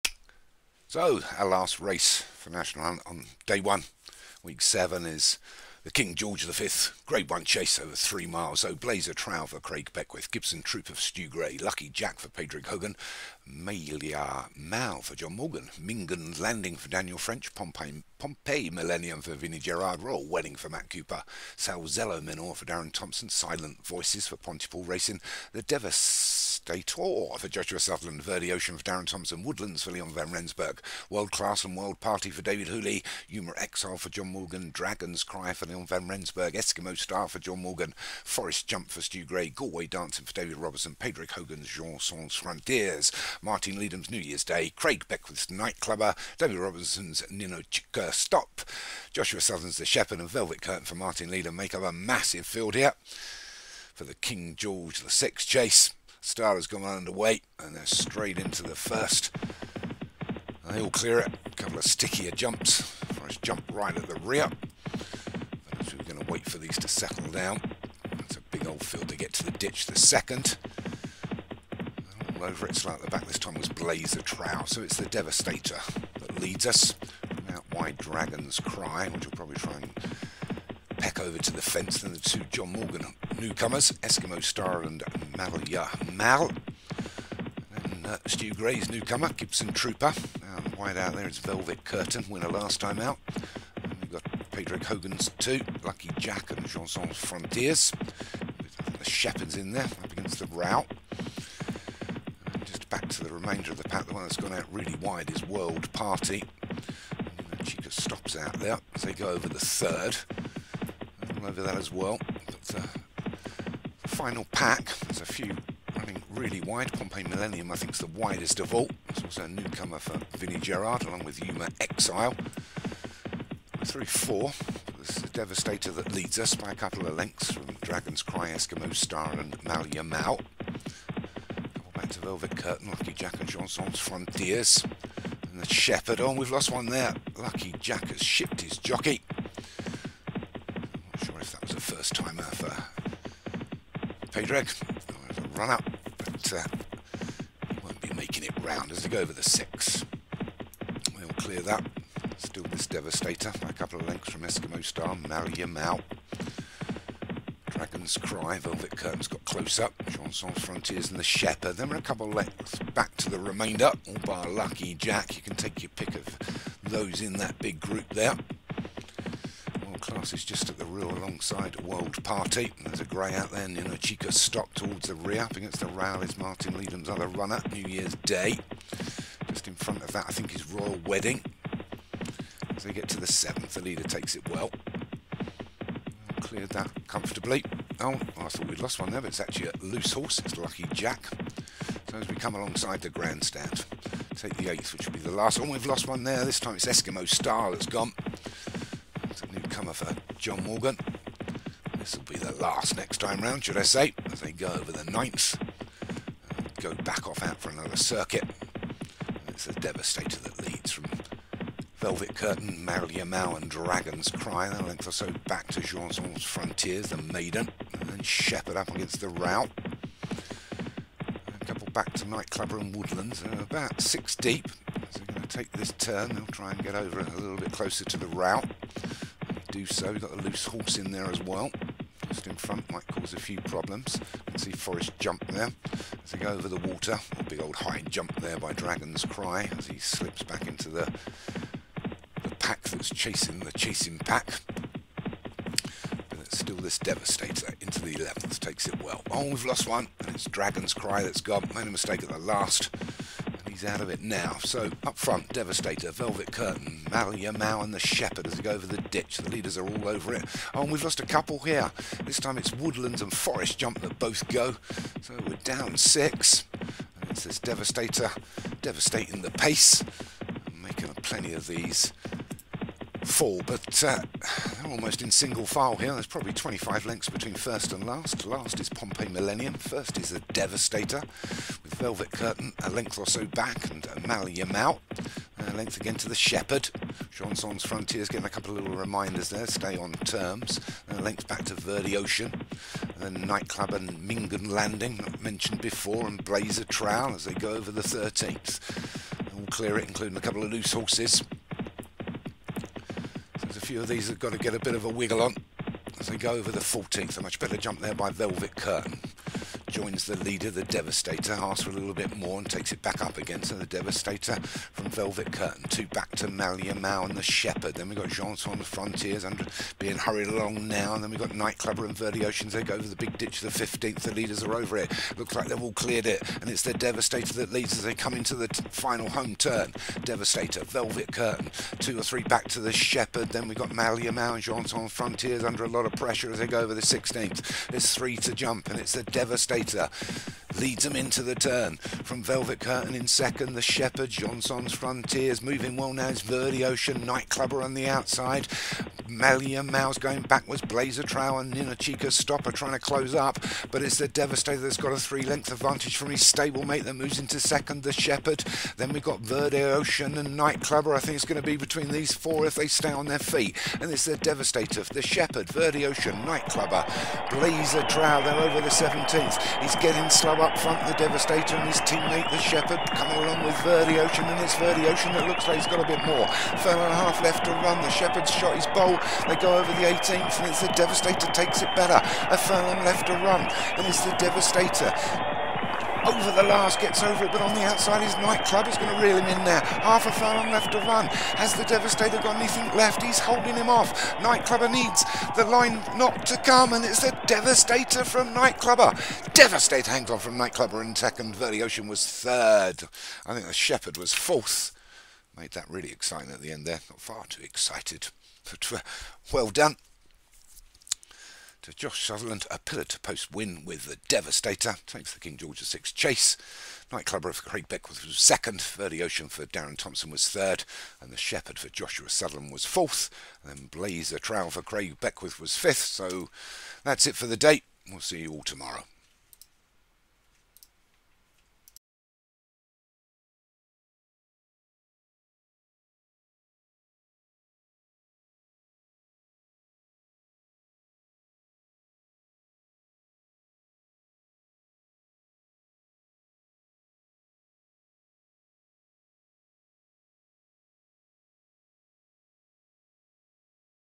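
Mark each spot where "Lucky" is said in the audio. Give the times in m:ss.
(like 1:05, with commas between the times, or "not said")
0:11, 1:35, 2:12, 2:17, 2:44, 3:10.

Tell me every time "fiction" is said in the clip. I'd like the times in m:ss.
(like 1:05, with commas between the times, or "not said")
not said.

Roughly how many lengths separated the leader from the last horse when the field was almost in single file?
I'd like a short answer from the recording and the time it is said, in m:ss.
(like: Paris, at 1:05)
25, at 4:36.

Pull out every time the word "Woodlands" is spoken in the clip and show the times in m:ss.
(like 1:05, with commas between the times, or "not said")
0:29, 3:42, 4:22.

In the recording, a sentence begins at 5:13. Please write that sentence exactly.
So the Devastator from Velvet Curtain, two back to Malia Mao and the Shepherd.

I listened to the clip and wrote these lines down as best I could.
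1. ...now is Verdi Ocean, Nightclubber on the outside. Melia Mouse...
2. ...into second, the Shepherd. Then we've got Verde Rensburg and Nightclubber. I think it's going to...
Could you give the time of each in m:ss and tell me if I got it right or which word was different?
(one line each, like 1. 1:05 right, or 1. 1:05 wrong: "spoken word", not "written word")
1. 5:46 right
2. 5:57 wrong: "Ocean", not "Rensburg".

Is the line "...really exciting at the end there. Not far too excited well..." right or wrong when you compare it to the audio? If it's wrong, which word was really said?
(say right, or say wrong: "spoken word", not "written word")
right.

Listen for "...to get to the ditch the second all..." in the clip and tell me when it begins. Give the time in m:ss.
1:09.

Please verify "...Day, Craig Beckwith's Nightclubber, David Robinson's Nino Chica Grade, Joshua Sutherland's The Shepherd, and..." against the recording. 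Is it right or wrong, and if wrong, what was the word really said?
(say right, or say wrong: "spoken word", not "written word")
wrong: "Stop", not "Grade".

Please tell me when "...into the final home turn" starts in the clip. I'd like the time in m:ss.
5:28.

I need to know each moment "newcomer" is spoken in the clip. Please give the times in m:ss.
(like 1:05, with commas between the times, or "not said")
1:23, 1:28, 1:59, 3:19.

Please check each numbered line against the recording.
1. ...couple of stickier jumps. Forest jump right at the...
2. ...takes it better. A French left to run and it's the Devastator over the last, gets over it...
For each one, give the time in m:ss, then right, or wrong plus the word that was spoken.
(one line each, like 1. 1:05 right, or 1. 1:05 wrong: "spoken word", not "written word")
1. 1:01 right
2. 6:21 wrong: "Furlong", not "French".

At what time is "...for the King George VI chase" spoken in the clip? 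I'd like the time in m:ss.
0:53.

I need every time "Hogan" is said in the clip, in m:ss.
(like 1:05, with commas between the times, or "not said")
0:12, 0:41, 1:34.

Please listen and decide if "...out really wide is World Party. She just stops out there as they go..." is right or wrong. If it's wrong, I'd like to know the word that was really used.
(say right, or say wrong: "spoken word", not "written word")
right.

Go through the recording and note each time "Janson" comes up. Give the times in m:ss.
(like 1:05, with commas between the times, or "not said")
3:35, 5:18, 5:34.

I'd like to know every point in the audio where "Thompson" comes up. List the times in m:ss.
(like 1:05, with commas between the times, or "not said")
0:22, 0:29, 6:59.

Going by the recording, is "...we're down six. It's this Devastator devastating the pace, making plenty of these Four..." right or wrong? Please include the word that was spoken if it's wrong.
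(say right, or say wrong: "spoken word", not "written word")
right.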